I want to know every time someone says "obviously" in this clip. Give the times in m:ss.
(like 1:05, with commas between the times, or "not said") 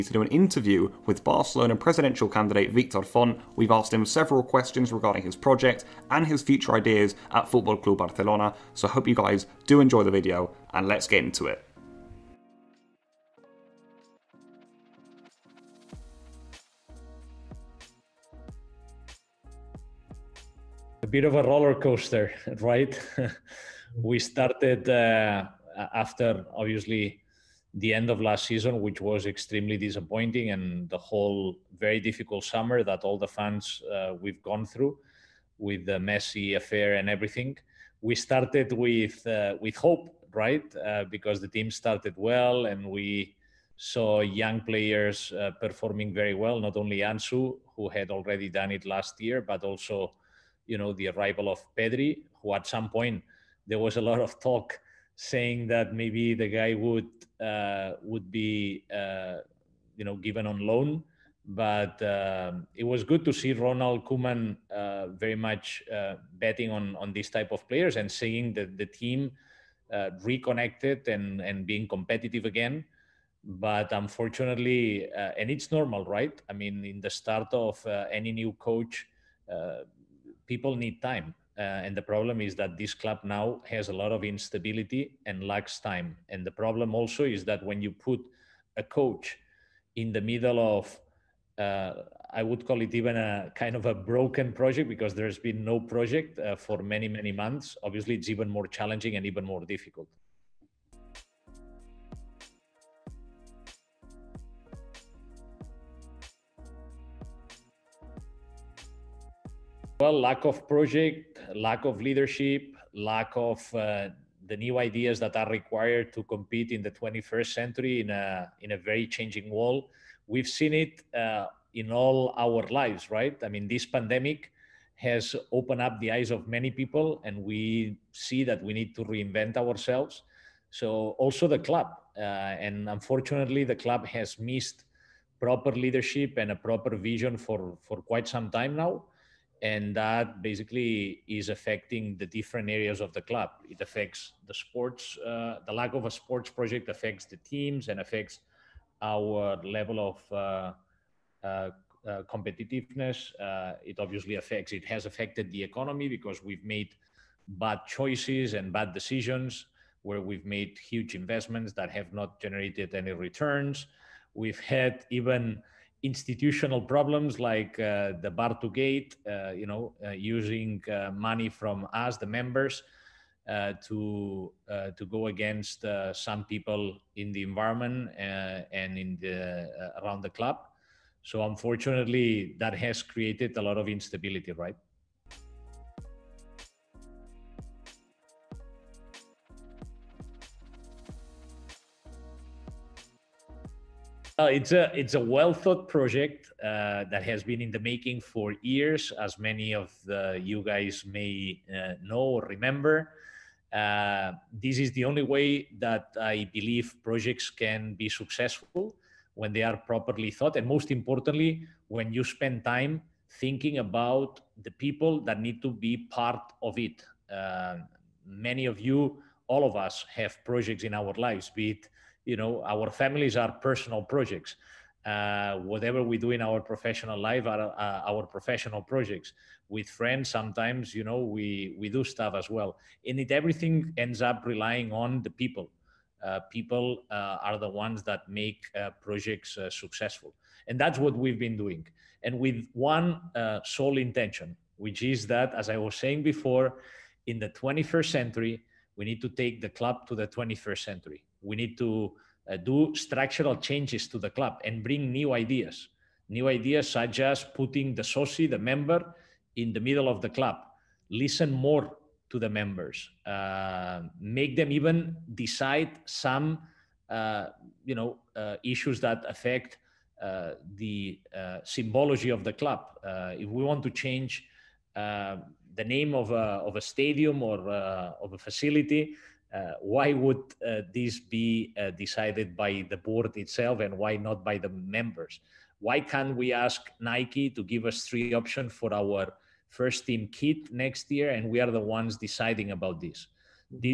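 0:26, 1:37, 2:33.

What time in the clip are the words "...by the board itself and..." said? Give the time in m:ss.
4:42.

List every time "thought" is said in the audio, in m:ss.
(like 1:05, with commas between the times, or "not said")
3:15, 3:30.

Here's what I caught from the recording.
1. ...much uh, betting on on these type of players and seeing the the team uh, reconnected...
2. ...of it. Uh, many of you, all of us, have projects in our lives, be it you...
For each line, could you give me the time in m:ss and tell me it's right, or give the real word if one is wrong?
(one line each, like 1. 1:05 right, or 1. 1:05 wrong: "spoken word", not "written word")
1. 1:05 right
2. 3:36 right.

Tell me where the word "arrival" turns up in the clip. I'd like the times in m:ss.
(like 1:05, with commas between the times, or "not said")
0:51.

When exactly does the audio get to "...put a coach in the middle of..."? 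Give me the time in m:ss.
1:27.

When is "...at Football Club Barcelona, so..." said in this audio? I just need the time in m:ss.
0:07.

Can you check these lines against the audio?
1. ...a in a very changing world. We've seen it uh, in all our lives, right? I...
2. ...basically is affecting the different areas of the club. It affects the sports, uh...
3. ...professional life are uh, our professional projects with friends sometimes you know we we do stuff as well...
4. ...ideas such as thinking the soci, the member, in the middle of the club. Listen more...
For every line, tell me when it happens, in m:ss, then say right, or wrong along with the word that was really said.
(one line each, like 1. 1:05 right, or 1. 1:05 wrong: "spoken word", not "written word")
1. 1:58 right
2. 2:20 right
3. 3:46 right
4. 4:16 wrong: "putting", not "thinking".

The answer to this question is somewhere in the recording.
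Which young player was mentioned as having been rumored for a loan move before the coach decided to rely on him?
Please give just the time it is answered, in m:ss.
0:51.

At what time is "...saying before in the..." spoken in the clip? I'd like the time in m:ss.
4:05.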